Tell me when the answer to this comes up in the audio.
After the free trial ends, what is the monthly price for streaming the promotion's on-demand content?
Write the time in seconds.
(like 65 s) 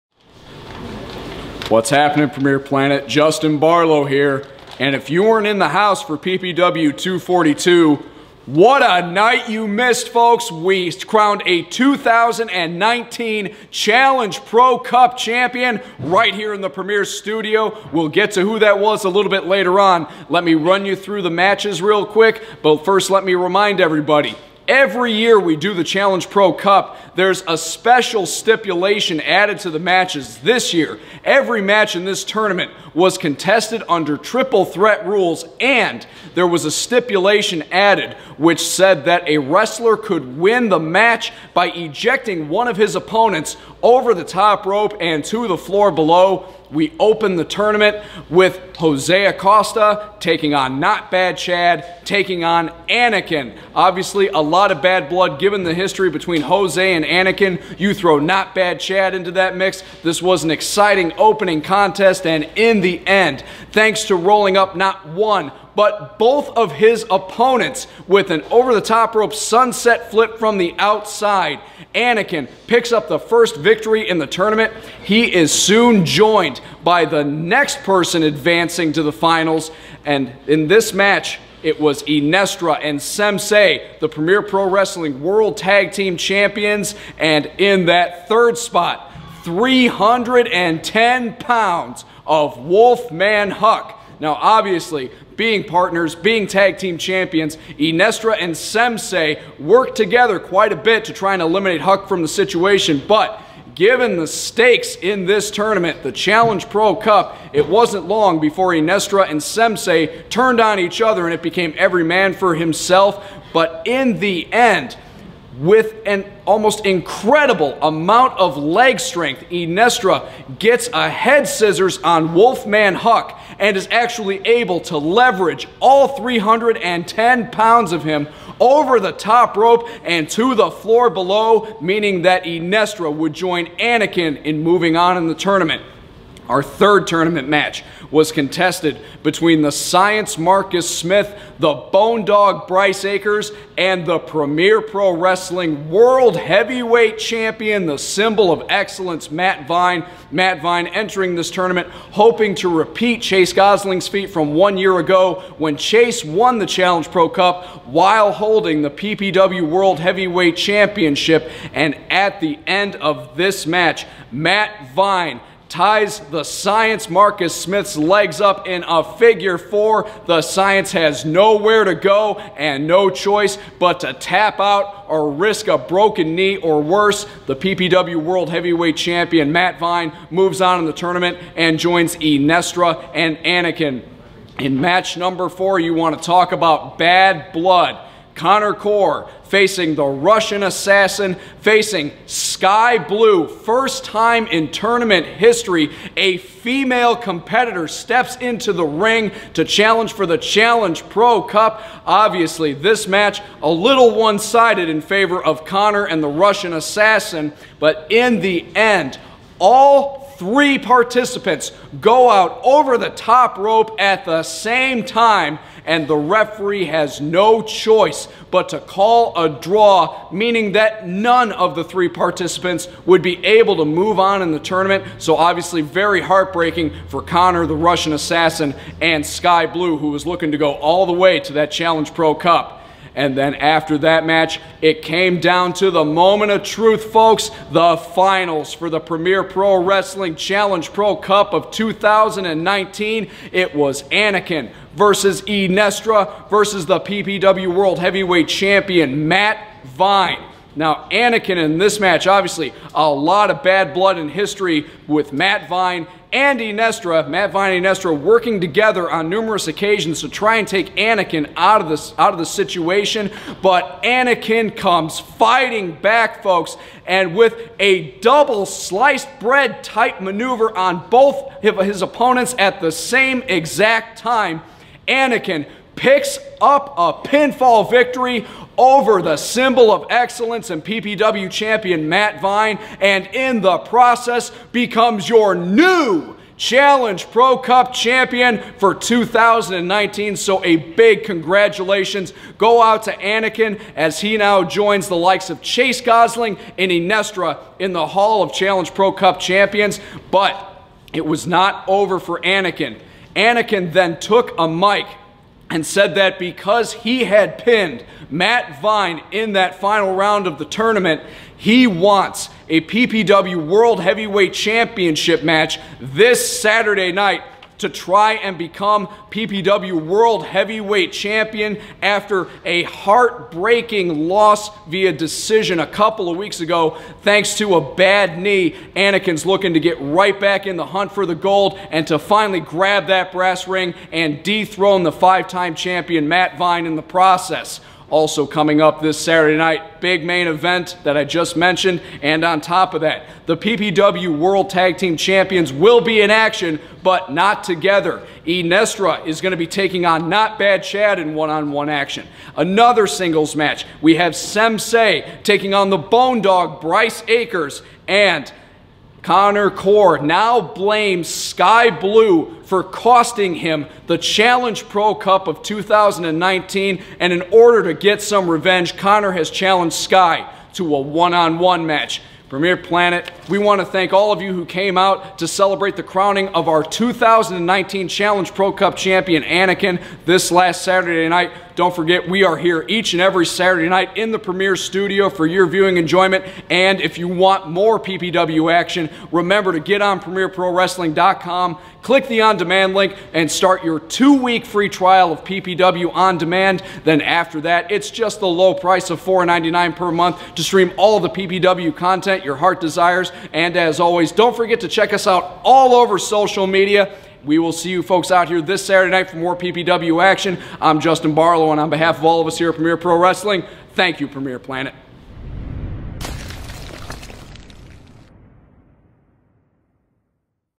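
399 s.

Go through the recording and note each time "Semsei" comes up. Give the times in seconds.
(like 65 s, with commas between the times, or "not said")
82 s, 98 s, 109 s, 354 s.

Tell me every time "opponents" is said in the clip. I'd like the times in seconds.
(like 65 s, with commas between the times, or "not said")
42 s, 67 s, 272 s.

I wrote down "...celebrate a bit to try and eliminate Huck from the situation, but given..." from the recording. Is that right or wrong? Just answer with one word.
wrong.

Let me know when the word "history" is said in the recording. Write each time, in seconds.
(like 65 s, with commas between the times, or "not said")
55 s, 195 s, 254 s.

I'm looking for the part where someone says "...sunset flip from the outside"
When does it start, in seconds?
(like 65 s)
69 s.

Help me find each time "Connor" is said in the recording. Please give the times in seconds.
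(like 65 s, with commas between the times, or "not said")
188 s, 205 s, 227 s, 359 s, 368 s.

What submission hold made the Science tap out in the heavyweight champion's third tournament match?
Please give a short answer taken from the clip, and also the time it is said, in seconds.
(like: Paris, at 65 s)
Figure four, at 169 s.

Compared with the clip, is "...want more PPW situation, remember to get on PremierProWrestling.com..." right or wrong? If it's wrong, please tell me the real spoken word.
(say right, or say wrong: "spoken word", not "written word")
wrong: "action", not "situation".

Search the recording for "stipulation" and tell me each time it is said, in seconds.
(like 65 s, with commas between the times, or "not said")
28 s, 36 s.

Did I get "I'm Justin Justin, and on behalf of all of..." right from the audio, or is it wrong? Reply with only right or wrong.
wrong.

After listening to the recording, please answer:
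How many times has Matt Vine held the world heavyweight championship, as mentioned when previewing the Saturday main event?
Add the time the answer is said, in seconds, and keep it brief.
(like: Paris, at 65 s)
5, at 335 s.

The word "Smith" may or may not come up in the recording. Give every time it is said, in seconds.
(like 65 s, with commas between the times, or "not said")
140 s, 167 s.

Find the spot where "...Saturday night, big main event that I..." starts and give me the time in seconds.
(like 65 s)
339 s.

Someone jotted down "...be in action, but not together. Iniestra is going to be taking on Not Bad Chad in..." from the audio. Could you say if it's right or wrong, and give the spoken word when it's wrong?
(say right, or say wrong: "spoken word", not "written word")
right.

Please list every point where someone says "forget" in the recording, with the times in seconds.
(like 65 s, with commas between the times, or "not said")
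381 s, 404 s.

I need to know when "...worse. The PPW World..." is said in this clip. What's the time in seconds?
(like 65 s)
176 s.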